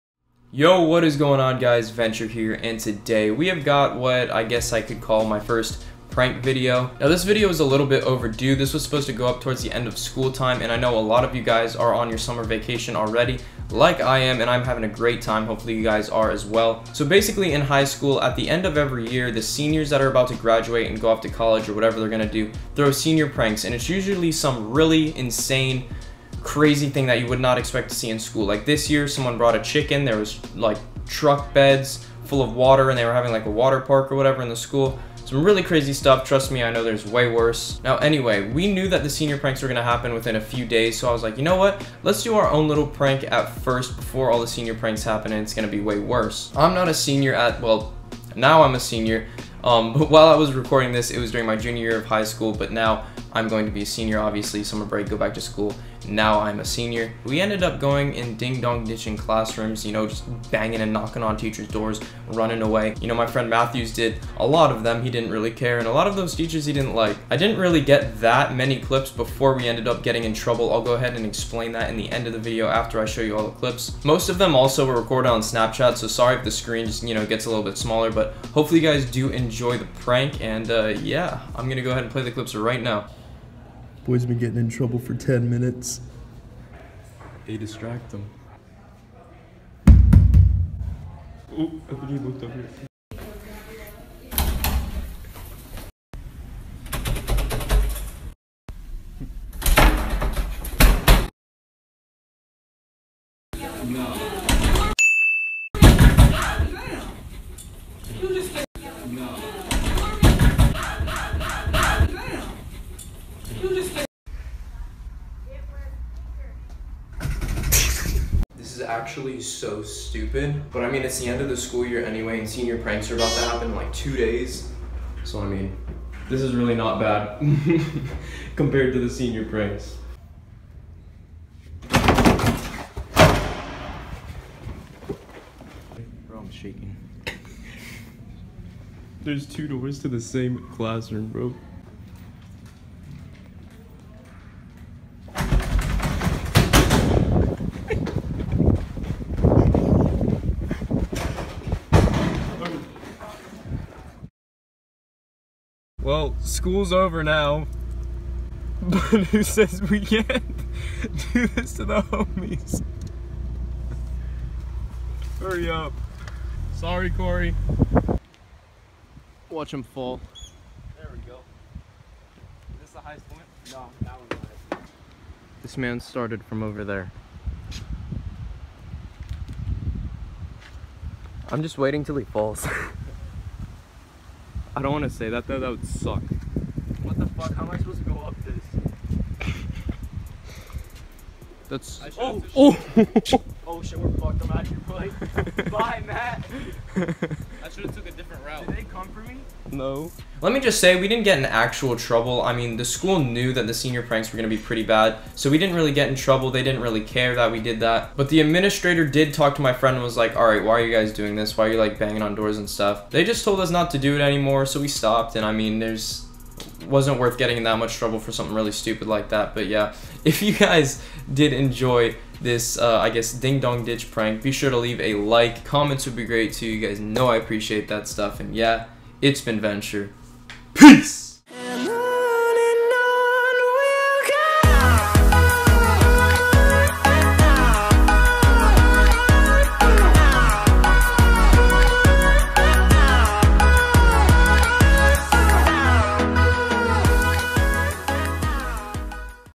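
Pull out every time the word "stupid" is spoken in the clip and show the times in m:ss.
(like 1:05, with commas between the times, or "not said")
1:59, 3:38.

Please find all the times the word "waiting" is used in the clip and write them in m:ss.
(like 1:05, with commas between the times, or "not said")
3:01.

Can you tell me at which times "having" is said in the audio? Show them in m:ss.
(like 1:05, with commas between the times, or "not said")
0:14, 0:33.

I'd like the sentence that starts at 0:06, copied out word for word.
Now this video is a little bit overdue.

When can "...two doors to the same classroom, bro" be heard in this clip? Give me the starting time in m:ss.
2:19.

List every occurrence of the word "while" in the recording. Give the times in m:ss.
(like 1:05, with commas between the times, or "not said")
0:50.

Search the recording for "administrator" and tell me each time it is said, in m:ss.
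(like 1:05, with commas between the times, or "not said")
3:28.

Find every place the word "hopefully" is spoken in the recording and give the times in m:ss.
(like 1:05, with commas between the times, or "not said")
0:15, 1:18.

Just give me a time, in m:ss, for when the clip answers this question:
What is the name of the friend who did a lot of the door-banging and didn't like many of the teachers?
1:03.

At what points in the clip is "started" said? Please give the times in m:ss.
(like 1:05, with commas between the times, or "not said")
2:56.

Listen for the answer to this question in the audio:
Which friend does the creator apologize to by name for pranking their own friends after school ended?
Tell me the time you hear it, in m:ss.
2:47.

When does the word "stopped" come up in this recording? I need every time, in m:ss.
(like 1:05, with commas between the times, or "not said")
3:34.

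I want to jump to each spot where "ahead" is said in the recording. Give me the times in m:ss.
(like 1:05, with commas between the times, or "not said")
1:10, 1:21.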